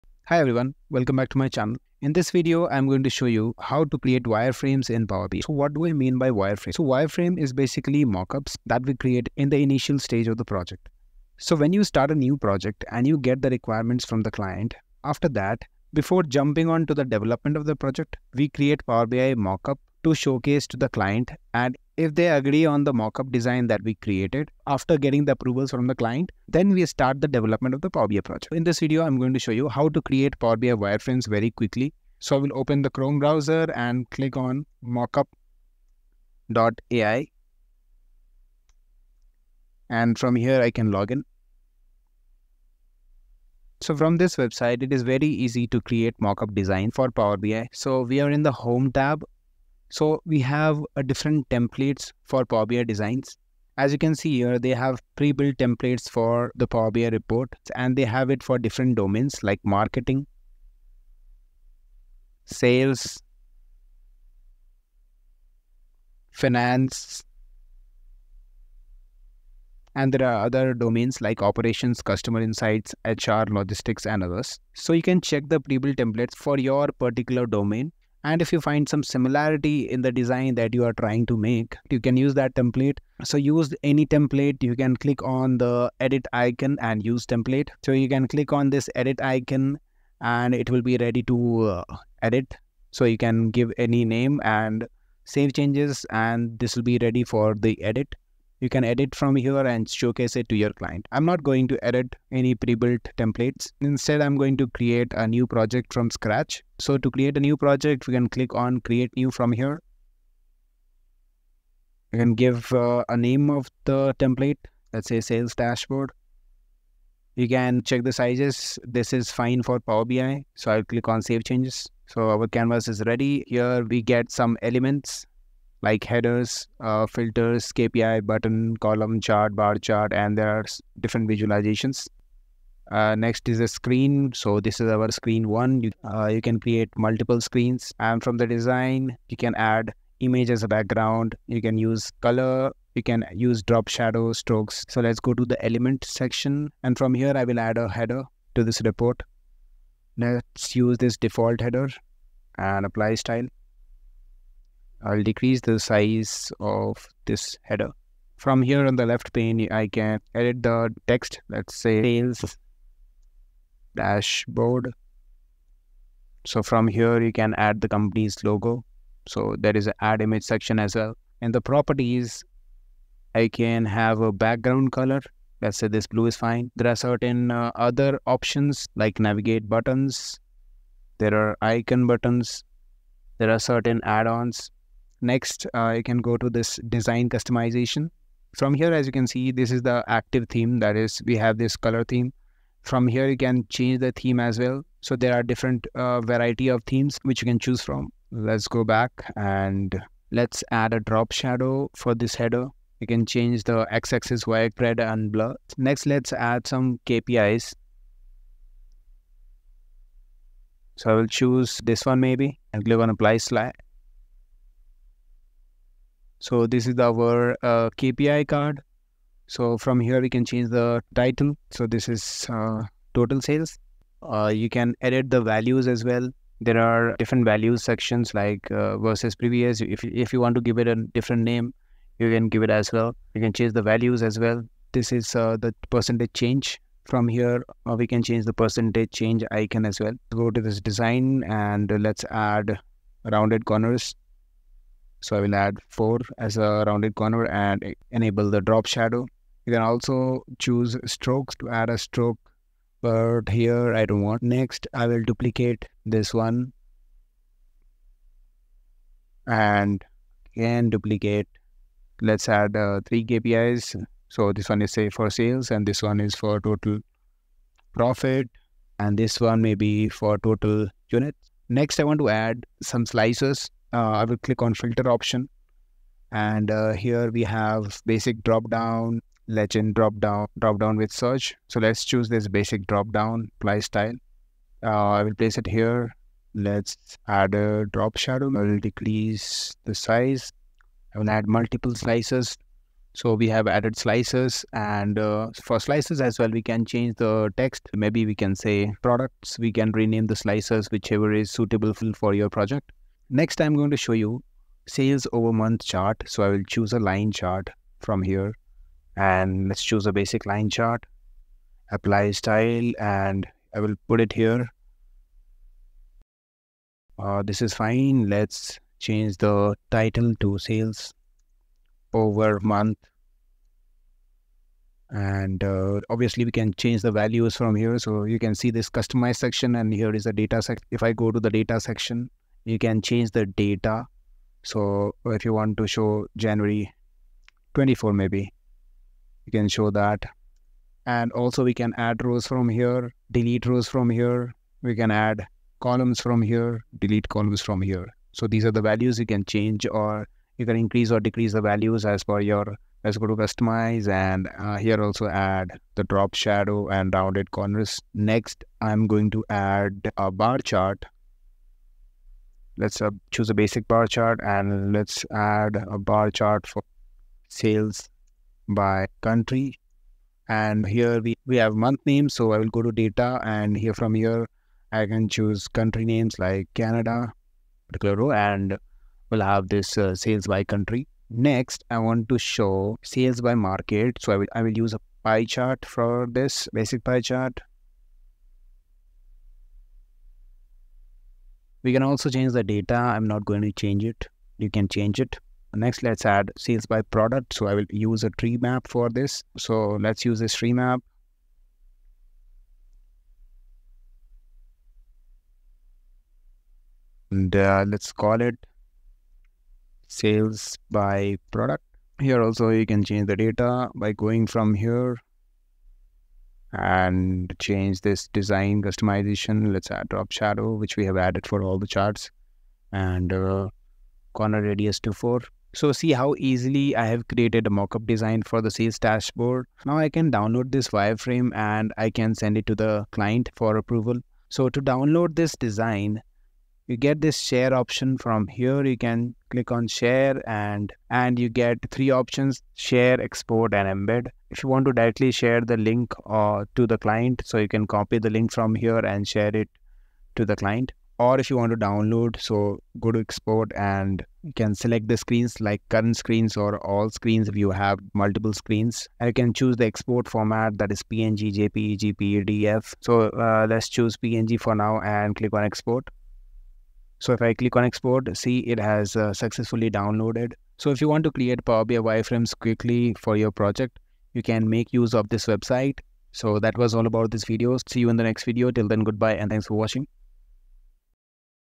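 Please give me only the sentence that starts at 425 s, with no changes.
So see how easily I have created a mockup design for the sales dashboard.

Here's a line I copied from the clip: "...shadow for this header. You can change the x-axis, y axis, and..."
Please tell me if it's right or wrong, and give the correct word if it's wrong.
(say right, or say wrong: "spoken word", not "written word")
right.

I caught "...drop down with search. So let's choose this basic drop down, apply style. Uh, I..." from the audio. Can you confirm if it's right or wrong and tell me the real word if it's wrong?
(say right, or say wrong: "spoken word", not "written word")
right.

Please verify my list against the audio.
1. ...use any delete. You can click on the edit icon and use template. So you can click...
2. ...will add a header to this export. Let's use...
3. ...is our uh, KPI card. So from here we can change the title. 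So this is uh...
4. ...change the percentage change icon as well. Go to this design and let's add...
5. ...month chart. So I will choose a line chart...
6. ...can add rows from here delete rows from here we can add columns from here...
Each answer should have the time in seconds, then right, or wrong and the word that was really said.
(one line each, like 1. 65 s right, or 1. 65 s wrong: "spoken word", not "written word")
1. 83 s wrong: "template", not "delete"
2. 147 s wrong: "report", not "export"
3. 216 s right
4. 238 s right
5. 305 s right
6. 341 s right.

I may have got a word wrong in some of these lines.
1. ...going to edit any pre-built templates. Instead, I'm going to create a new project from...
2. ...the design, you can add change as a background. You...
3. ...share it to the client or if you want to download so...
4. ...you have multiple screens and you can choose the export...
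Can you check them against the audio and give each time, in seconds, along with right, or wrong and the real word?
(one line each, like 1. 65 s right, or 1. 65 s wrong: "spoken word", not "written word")
1. 101 s right
2. 138 s wrong: "image", not "change"
3. 449 s right
4. 457 s right.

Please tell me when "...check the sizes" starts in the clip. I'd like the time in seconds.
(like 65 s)
117 s.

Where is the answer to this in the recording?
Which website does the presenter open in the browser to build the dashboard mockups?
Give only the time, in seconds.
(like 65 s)
34 s.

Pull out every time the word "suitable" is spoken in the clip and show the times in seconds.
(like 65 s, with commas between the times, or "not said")
301 s.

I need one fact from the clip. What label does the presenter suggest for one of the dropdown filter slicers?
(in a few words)
Products.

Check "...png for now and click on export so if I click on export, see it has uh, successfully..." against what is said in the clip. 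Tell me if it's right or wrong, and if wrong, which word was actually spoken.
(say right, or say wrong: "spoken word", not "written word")
right.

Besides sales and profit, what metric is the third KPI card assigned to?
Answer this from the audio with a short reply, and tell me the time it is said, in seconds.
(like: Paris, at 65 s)
Total units, at 270 s.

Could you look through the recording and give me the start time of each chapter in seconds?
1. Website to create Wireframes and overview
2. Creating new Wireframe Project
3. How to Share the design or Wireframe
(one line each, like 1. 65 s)
1. 29 s
2. 104 s
3. 430 s.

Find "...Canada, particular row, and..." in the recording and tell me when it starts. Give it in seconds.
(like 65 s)
376 s.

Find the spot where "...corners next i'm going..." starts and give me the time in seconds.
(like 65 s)
357 s.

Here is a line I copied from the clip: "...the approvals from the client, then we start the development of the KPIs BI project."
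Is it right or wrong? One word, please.
wrong.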